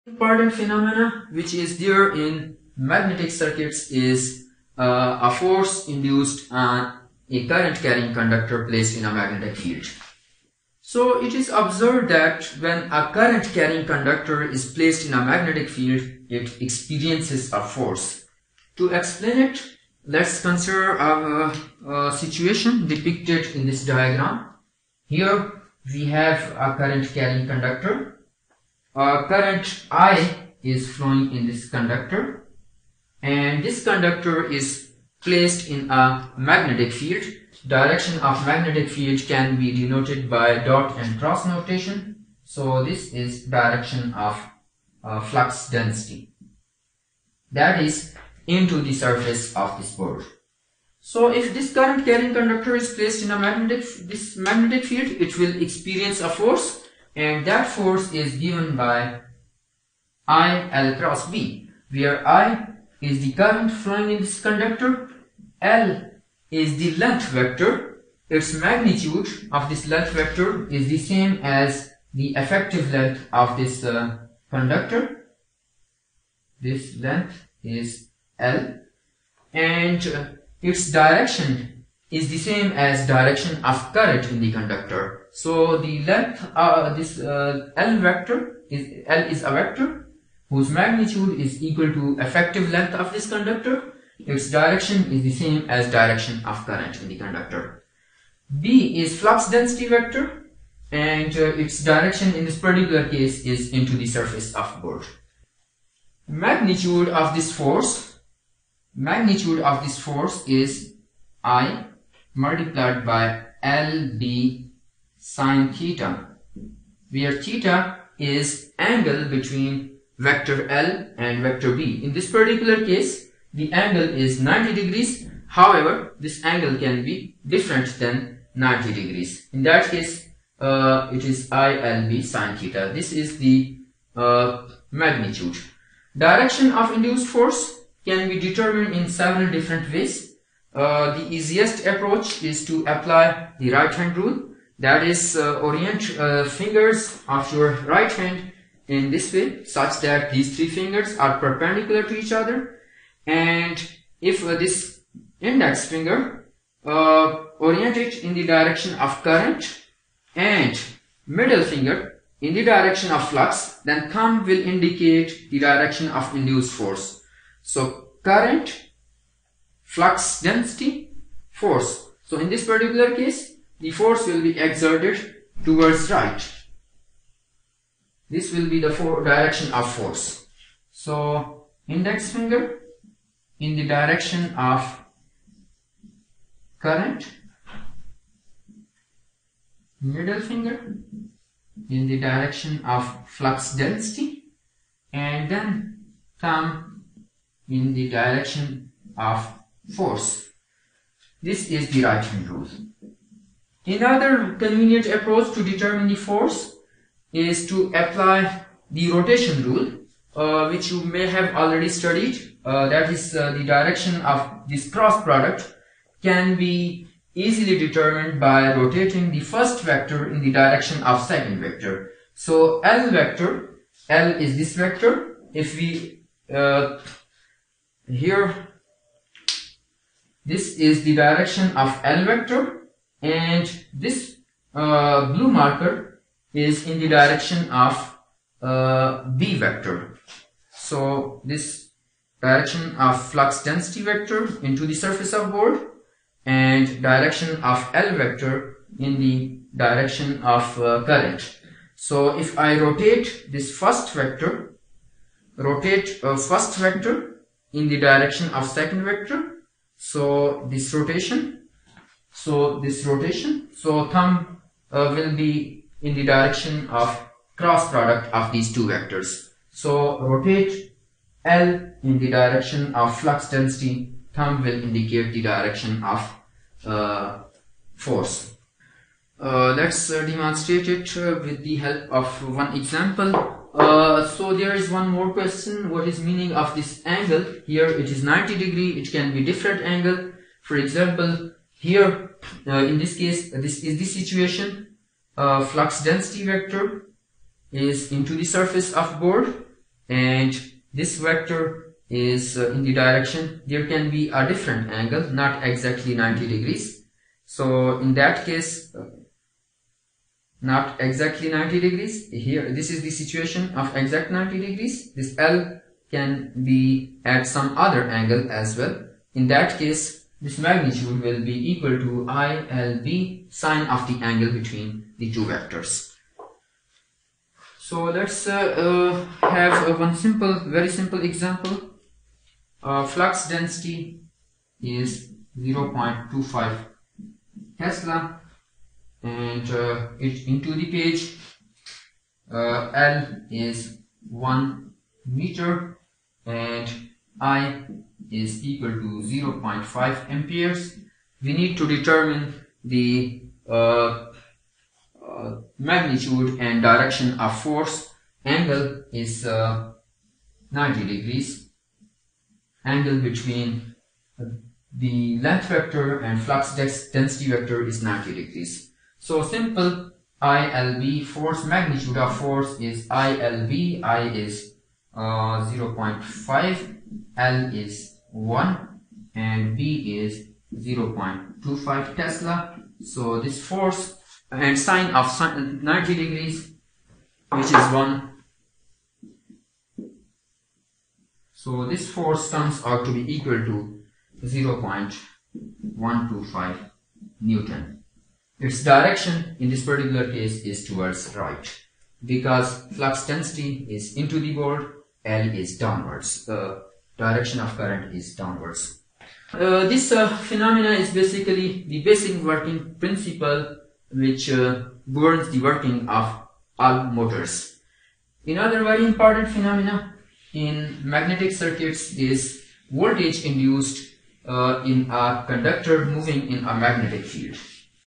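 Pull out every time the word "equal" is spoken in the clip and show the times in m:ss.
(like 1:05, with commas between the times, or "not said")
1:31, 5:21, 5:48, 6:33.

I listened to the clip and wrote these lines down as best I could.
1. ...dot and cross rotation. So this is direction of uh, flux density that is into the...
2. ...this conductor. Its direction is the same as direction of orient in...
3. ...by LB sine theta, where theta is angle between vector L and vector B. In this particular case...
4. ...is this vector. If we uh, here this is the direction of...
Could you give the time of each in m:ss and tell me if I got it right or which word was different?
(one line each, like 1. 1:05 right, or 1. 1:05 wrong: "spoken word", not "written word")
1. 0:40 wrong: "notation", not "rotation"
2. 1:33 wrong: "current", not "orient"
3. 1:53 right
4. 3:44 right.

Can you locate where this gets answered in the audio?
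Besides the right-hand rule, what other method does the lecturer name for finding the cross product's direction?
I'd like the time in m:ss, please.
3:29.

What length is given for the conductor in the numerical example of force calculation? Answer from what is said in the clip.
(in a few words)
1 meter.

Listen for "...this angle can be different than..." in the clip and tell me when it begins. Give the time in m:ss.
2:06.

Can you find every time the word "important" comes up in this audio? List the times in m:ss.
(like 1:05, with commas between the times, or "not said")
0:00, 6:59.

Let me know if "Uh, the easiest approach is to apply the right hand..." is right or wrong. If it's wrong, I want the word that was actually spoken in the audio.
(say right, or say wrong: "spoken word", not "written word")
right.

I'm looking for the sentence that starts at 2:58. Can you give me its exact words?
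This will be the direction of force.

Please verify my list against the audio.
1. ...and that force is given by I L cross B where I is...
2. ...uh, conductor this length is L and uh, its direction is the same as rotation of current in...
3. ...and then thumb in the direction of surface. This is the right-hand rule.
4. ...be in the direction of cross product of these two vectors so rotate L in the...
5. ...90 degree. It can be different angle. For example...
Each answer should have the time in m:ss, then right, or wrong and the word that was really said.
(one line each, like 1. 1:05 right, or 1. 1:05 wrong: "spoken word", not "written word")
1. 0:57 right
2. 1:13 wrong: "direction", not "rotation"
3. 3:15 wrong: "force", not "surface"
4. 4:25 right
5. 4:48 right.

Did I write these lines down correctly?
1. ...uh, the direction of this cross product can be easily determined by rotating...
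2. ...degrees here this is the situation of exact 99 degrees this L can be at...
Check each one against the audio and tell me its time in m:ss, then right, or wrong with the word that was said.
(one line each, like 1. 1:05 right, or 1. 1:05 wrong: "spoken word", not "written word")
1. 3:33 right
2. 5:11 wrong: "90", not "99".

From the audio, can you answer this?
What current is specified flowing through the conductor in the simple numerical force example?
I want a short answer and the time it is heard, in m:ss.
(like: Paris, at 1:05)
0.5 amperes, at 5:49.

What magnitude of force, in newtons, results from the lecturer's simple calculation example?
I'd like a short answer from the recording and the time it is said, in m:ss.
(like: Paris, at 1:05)
0.125 newton, at 6:34.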